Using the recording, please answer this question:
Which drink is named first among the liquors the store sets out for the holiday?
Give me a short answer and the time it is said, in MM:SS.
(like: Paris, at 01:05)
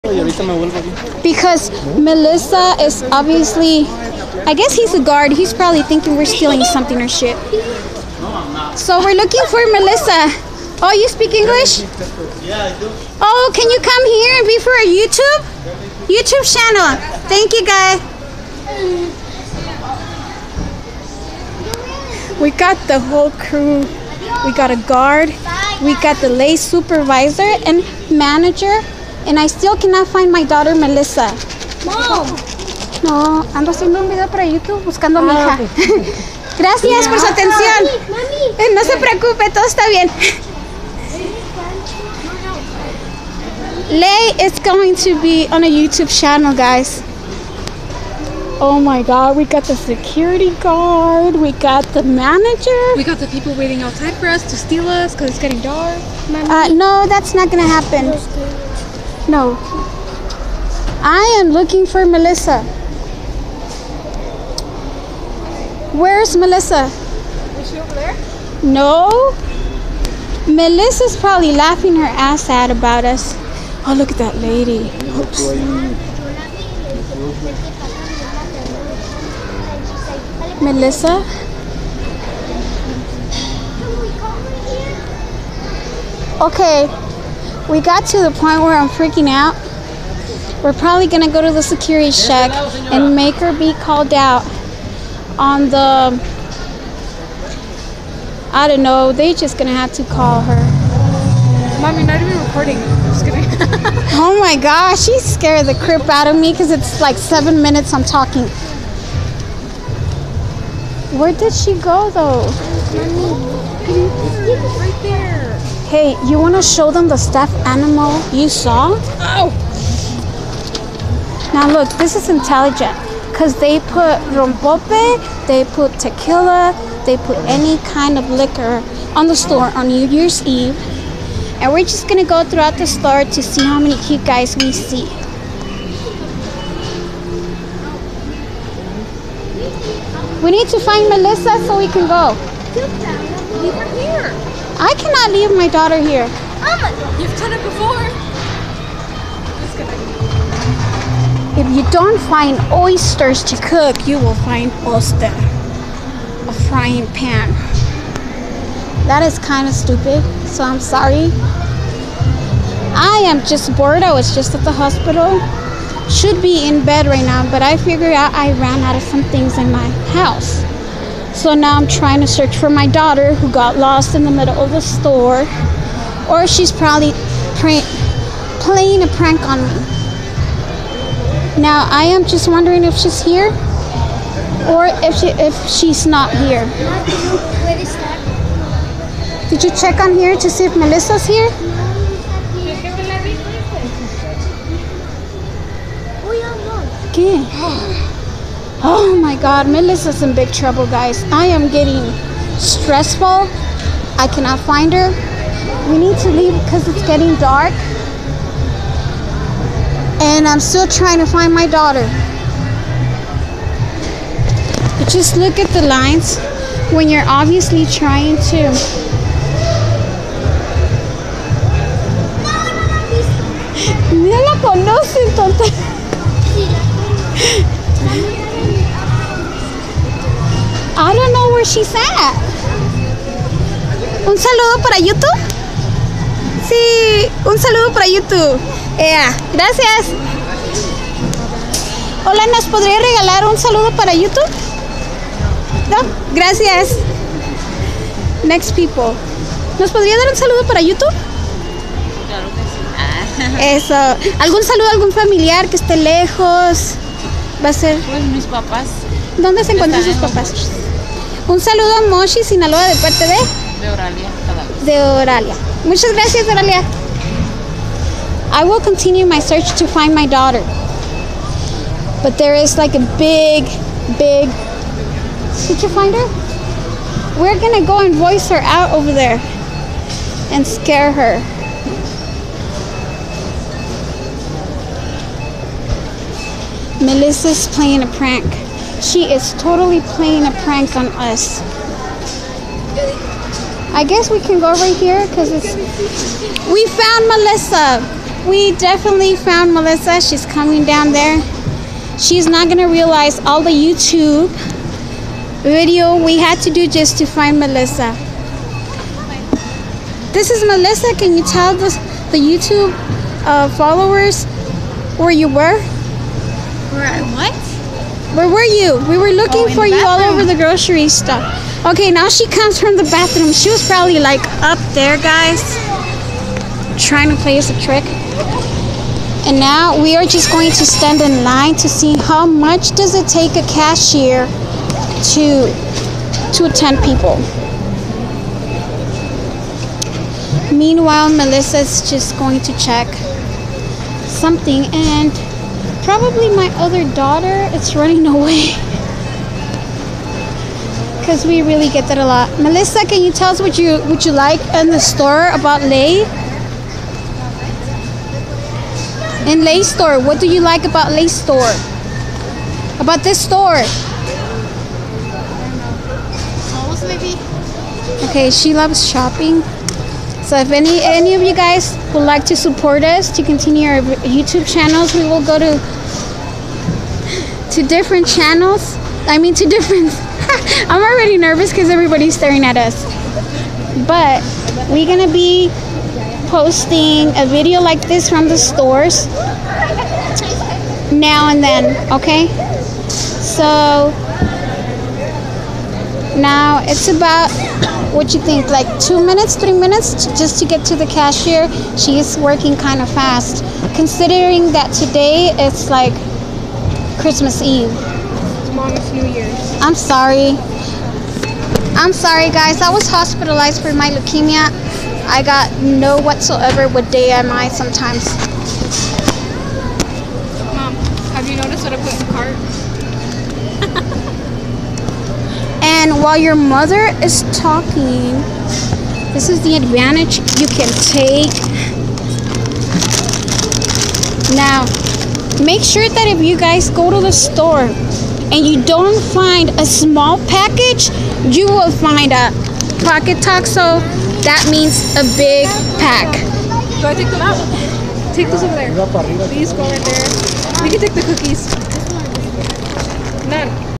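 rompope, at 02:04.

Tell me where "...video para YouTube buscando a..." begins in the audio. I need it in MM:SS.
00:34.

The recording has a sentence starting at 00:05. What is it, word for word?
He's probably thinking we're stealing something or shit.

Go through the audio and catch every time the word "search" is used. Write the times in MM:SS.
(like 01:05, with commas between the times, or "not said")
02:52, 04:29.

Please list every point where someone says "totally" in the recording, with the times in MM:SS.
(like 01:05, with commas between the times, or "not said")
04:49.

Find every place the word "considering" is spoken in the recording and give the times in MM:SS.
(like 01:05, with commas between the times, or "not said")
06:43.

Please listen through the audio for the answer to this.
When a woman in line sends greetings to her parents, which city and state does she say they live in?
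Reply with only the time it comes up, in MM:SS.
04:22.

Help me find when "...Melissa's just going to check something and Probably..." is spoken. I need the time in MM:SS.
05:41.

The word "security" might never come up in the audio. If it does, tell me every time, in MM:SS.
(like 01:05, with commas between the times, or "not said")
00:49, 01:31.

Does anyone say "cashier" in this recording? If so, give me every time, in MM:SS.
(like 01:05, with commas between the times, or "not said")
05:33, 06:41.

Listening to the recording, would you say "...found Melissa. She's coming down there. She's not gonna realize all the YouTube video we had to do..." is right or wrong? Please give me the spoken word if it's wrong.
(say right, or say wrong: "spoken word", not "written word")
right.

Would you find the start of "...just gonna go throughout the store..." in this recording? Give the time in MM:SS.
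02:11.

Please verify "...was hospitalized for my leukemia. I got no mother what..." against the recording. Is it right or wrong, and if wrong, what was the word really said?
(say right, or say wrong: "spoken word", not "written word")
wrong: "whatsoever", not "mother".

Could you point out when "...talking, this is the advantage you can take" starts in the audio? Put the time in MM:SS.
07:07.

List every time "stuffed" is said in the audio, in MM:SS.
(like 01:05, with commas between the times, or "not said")
01:57.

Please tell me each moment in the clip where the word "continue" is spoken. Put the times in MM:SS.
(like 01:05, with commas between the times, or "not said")
04:28, 06:13.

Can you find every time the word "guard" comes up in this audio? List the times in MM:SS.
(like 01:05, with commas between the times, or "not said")
00:05, 00:24, 00:50.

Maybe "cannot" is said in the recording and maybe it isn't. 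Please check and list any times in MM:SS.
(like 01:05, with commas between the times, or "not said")
00:29, 02:24, 03:24.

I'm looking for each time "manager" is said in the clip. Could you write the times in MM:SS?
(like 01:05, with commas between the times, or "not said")
00:28, 00:52.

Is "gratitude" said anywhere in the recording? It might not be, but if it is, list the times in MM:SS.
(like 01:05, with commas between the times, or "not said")
not said.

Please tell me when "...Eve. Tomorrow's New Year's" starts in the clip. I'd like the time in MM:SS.
06:47.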